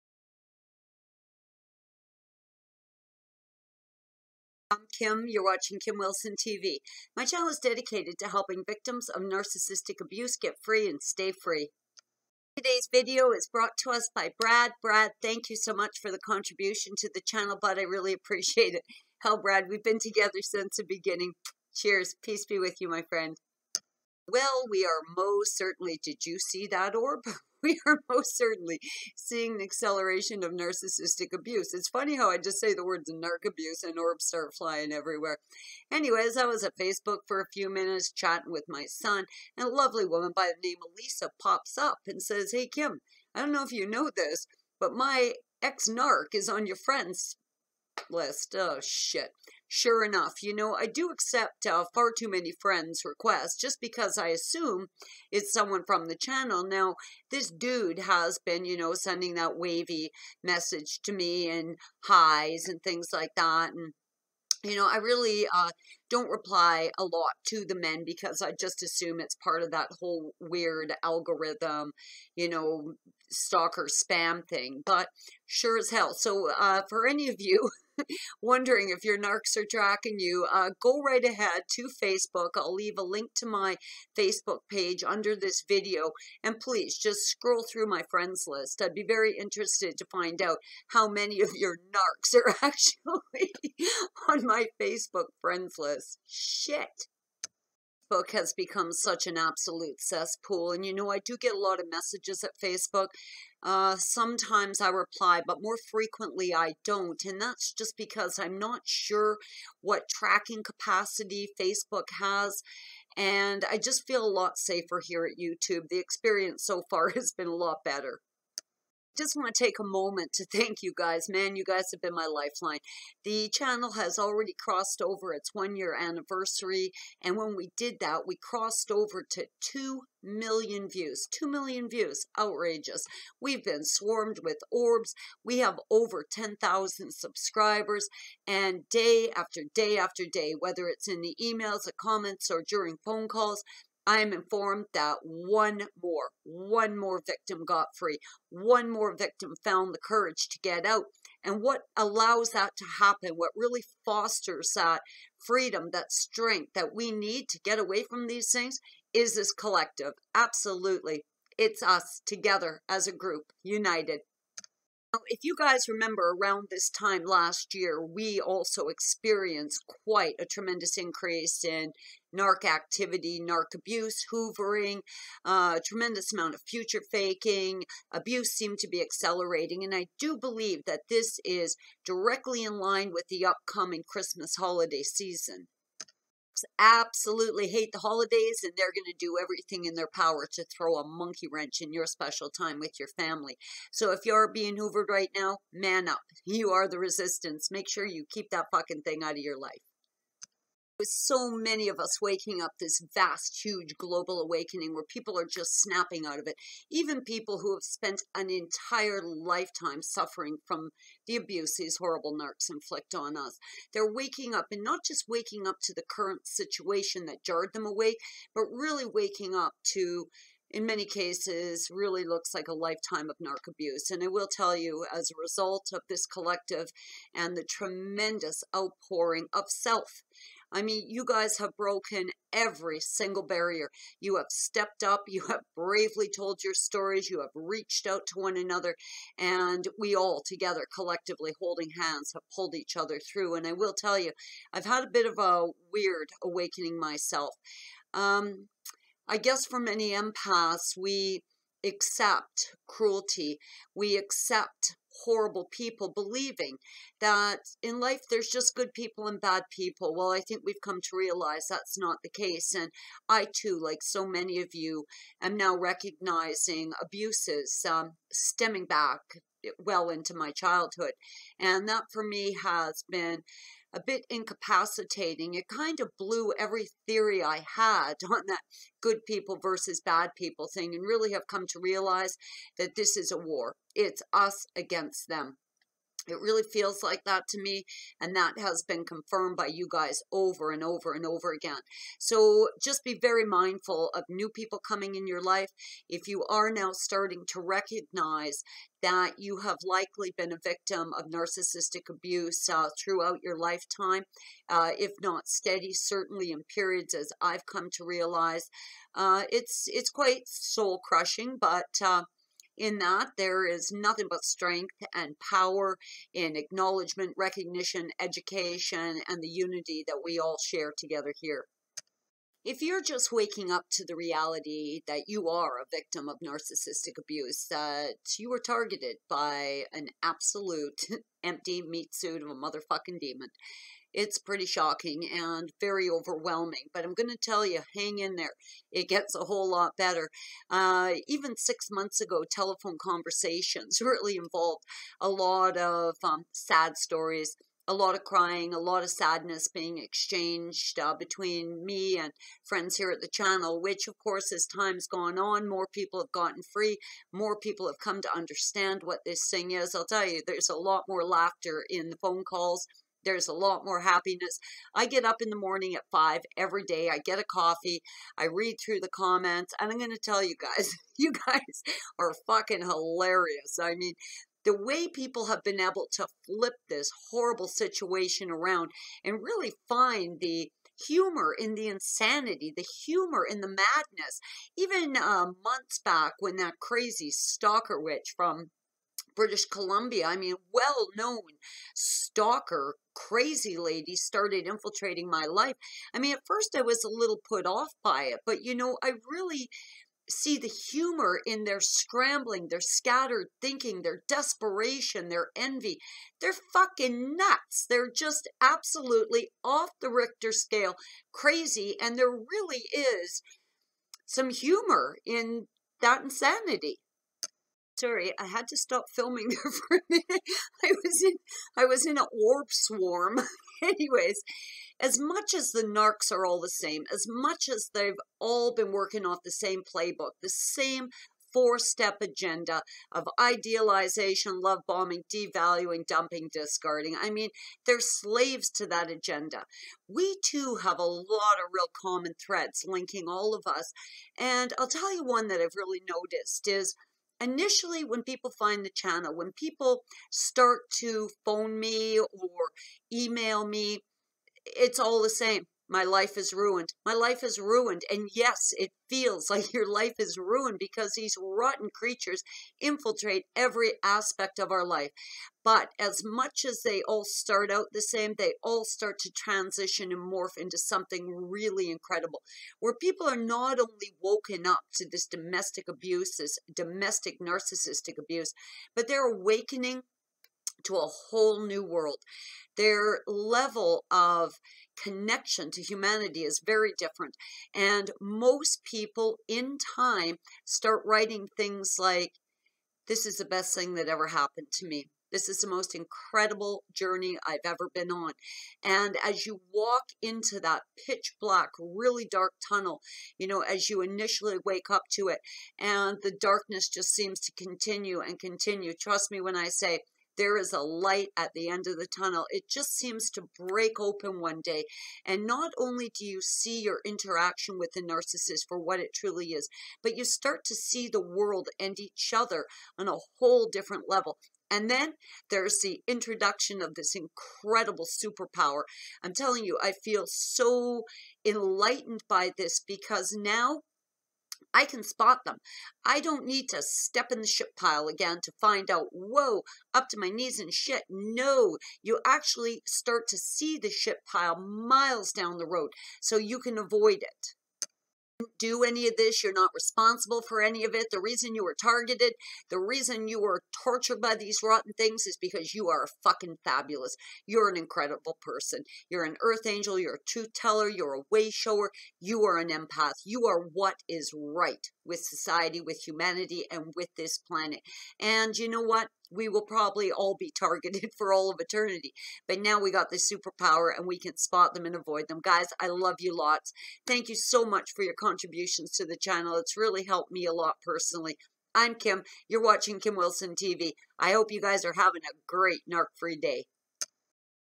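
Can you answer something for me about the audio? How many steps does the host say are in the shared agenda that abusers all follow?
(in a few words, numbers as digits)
4.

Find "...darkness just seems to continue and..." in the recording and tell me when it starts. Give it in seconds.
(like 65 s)
506 s.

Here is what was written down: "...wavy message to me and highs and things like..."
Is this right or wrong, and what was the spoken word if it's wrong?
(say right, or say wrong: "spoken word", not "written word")
right.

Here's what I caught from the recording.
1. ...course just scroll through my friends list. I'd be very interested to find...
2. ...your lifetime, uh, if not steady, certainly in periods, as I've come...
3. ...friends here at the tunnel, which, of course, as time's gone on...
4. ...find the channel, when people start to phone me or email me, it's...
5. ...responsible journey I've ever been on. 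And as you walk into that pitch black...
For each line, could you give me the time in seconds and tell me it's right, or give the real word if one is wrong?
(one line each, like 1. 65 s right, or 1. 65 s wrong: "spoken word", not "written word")
1. 86 s wrong: "please", not "course"
2. 303 s right
3. 352 s wrong: "channel", not "tunnel"
4. 448 s right
5. 495 s wrong: "incredible", not "responsible".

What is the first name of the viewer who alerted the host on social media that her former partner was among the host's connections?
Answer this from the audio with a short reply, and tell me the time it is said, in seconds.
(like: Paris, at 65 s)
Lisa, at 40 s.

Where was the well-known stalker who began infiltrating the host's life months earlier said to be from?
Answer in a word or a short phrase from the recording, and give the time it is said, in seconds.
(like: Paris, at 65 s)
British Columbia, at 389 s.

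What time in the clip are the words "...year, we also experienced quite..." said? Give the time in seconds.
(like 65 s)
167 s.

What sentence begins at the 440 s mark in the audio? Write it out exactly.
We too have a lot of real common threads linking all of us.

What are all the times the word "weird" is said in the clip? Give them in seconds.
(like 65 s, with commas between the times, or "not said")
70 s, 245 s.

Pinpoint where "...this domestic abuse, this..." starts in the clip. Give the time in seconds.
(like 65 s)
475 s.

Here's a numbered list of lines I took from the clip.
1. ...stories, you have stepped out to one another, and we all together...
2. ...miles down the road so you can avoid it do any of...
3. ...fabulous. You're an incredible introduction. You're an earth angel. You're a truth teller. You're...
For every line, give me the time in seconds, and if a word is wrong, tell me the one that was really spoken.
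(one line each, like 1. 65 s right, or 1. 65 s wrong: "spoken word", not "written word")
1. 236 s wrong: "reached", not "stepped"
2. 544 s right
3. 556 s wrong: "person", not "introduction".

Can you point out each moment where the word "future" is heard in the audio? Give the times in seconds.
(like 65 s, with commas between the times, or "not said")
176 s.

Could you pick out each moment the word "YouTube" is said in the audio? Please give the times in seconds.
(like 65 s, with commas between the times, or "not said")
115 s.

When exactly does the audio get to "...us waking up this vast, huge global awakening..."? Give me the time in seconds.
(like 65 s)
201 s.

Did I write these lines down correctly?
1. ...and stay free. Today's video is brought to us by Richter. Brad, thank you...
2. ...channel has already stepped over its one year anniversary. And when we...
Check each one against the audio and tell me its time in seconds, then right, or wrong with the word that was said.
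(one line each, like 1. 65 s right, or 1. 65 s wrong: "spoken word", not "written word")
1. 10 s wrong: "Brad", not "Richter"
2. 123 s wrong: "crossed", not "stepped".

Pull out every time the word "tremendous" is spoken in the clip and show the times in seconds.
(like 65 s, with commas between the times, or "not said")
170 s, 175 s, 227 s.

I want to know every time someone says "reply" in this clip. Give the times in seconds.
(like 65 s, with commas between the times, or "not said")
66 s, 104 s.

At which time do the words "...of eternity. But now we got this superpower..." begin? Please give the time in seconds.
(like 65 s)
571 s.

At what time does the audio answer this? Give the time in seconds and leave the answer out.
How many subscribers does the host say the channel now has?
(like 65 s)
135 s.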